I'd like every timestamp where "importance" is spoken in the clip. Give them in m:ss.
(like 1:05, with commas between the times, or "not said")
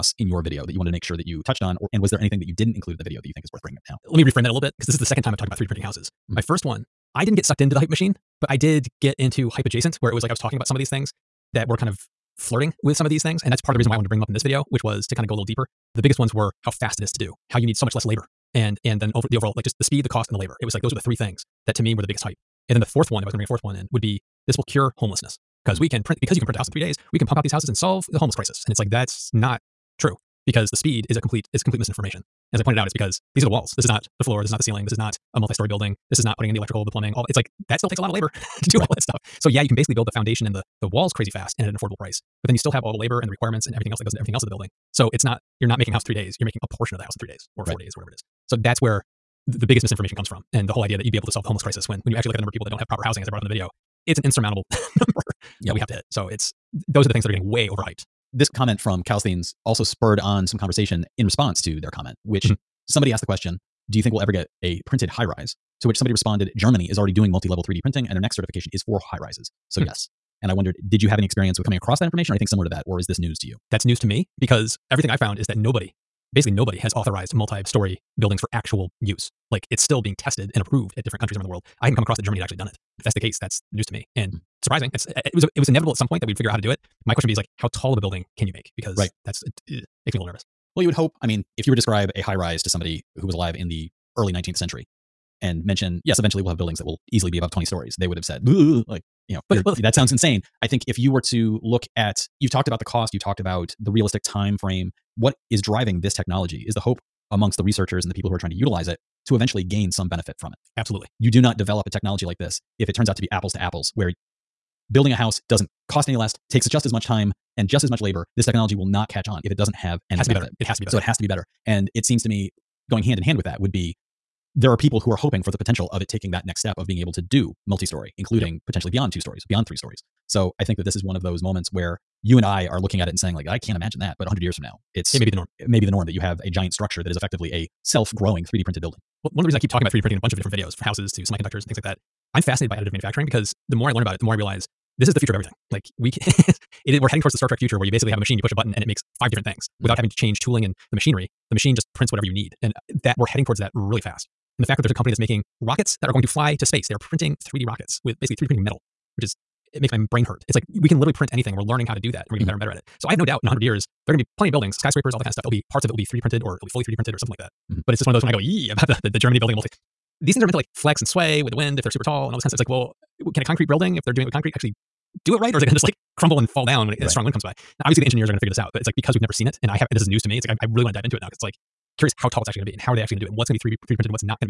not said.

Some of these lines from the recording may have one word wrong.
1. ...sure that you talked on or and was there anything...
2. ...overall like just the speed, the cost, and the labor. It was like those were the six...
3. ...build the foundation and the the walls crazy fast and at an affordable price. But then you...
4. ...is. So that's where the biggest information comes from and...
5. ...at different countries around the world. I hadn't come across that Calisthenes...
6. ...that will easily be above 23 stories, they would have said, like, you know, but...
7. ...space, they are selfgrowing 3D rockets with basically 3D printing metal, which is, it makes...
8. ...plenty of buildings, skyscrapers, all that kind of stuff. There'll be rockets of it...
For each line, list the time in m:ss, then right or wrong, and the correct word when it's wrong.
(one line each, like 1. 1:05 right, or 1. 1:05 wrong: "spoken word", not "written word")
1. 0:01 wrong: "touched", not "talked"
2. 0:19 wrong: "three", not "six"
3. 0:39 right
4. 0:48 wrong: "misinformation", not "information"
5. 1:20 wrong: "Germany", not "Calisthenes"
6. 1:36 wrong: "20", not "23"
7. 2:36 wrong: "printing", not "selfgrowing"
8. 2:44 wrong: "parts", not "rockets".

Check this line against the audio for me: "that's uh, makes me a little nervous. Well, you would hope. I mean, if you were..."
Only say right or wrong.
right.